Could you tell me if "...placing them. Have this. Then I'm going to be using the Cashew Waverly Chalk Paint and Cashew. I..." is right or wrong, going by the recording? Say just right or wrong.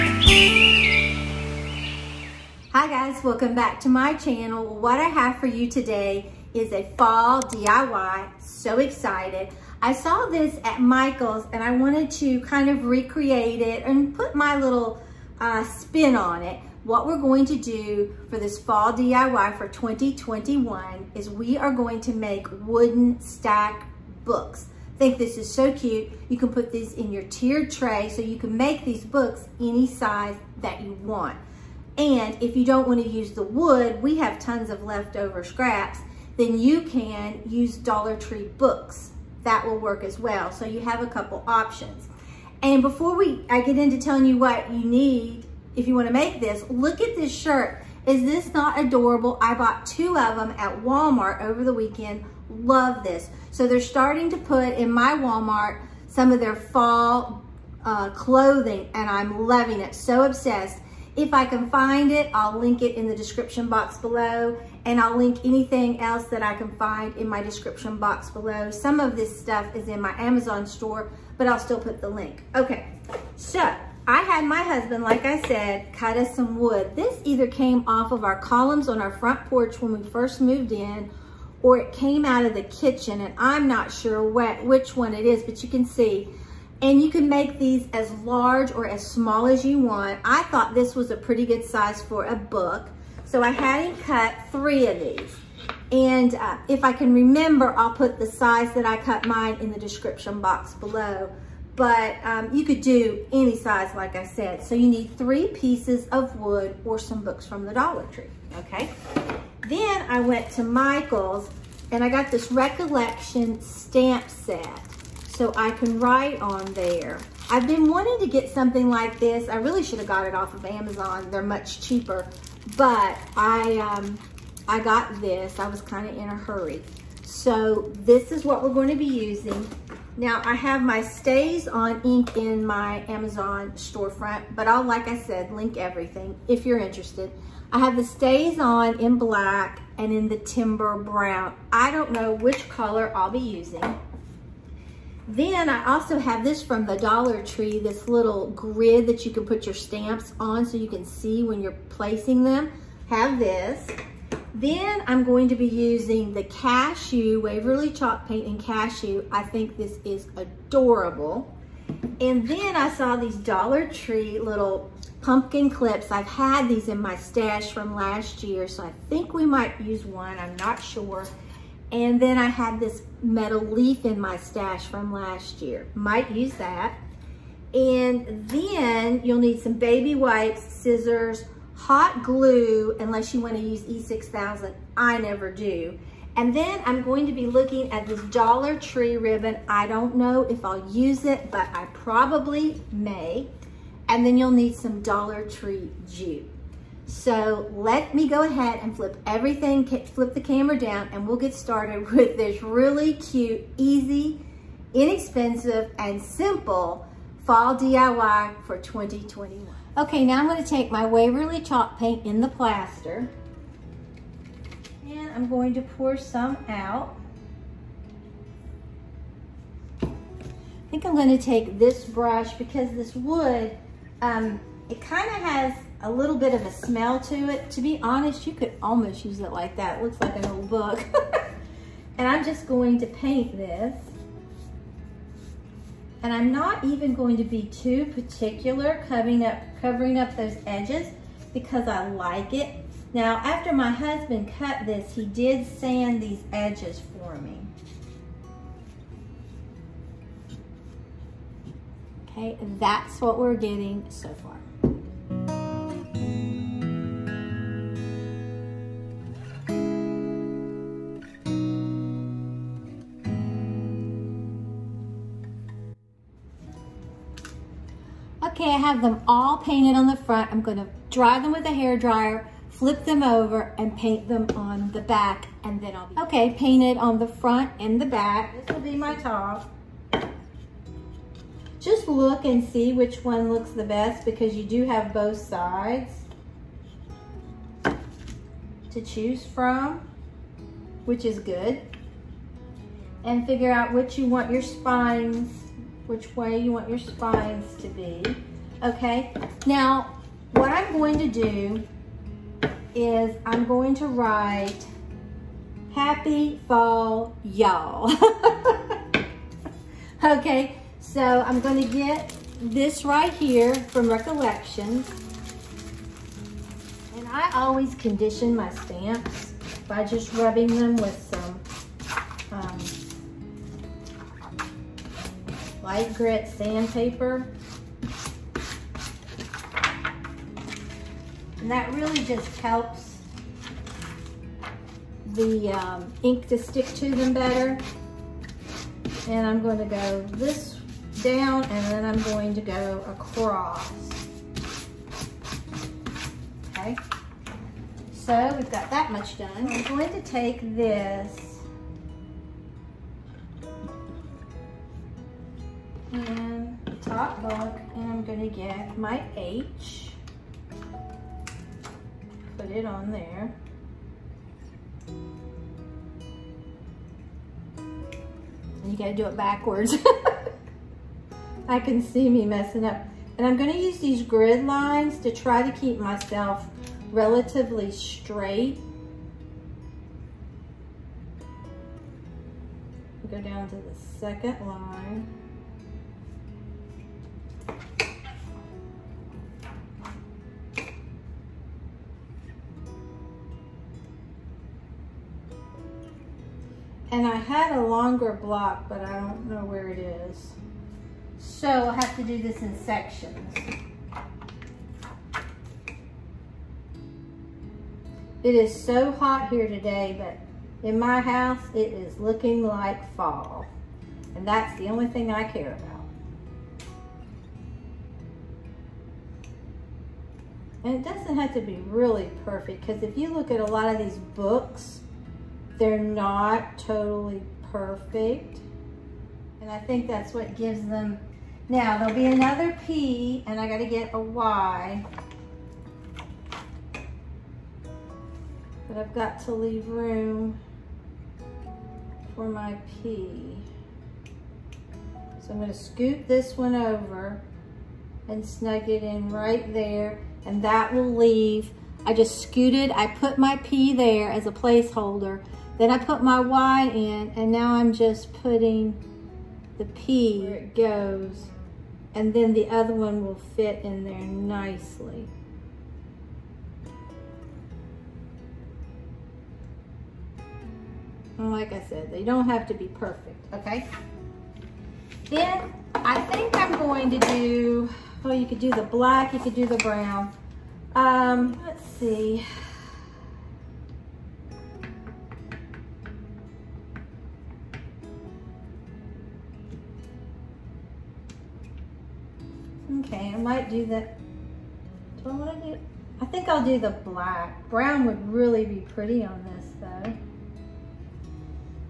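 right.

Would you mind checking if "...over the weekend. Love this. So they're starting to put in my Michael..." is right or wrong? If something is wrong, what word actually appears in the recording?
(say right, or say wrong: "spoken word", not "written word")
wrong: "Walmart", not "Michael".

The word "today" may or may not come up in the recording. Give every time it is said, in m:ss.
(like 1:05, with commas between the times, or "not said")
0:05, 6:49.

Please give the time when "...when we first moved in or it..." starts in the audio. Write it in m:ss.
1:19.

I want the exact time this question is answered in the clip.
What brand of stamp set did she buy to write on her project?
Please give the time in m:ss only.
1:52.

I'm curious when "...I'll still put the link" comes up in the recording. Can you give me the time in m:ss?
1:11.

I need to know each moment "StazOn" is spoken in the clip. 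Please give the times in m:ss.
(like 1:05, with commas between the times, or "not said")
2:10, 2:18.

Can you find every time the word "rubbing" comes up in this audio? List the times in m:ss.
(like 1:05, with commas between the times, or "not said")
5:20.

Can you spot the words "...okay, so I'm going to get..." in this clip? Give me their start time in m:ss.
5:10.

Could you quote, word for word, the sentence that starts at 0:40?
So you have a couple options.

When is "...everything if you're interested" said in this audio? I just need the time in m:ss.
2:15.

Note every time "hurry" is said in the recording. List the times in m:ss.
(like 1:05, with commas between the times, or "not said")
2:06.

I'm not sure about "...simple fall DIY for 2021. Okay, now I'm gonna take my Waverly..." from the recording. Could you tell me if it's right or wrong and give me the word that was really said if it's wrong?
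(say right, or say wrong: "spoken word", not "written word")
right.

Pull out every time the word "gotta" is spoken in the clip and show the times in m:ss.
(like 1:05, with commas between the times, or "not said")
6:08, 7:13.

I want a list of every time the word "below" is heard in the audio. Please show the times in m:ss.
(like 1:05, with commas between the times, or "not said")
1:03, 1:08, 1:40.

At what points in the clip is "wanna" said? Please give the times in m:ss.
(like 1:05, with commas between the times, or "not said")
3:03, 8:15.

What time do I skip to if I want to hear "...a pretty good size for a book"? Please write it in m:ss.
1:31.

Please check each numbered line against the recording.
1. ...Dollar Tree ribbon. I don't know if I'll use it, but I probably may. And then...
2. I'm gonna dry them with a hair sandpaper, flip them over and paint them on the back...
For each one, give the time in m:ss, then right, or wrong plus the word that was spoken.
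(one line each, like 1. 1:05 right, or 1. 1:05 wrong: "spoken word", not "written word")
1. 3:08 right
2. 4:30 wrong: "dryer", not "sandpaper".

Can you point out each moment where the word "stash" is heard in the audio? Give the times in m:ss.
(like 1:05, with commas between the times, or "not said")
2:47, 2:54.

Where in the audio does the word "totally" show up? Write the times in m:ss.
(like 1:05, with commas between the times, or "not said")
7:06.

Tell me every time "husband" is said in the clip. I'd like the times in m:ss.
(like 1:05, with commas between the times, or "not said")
1:14, 4:03.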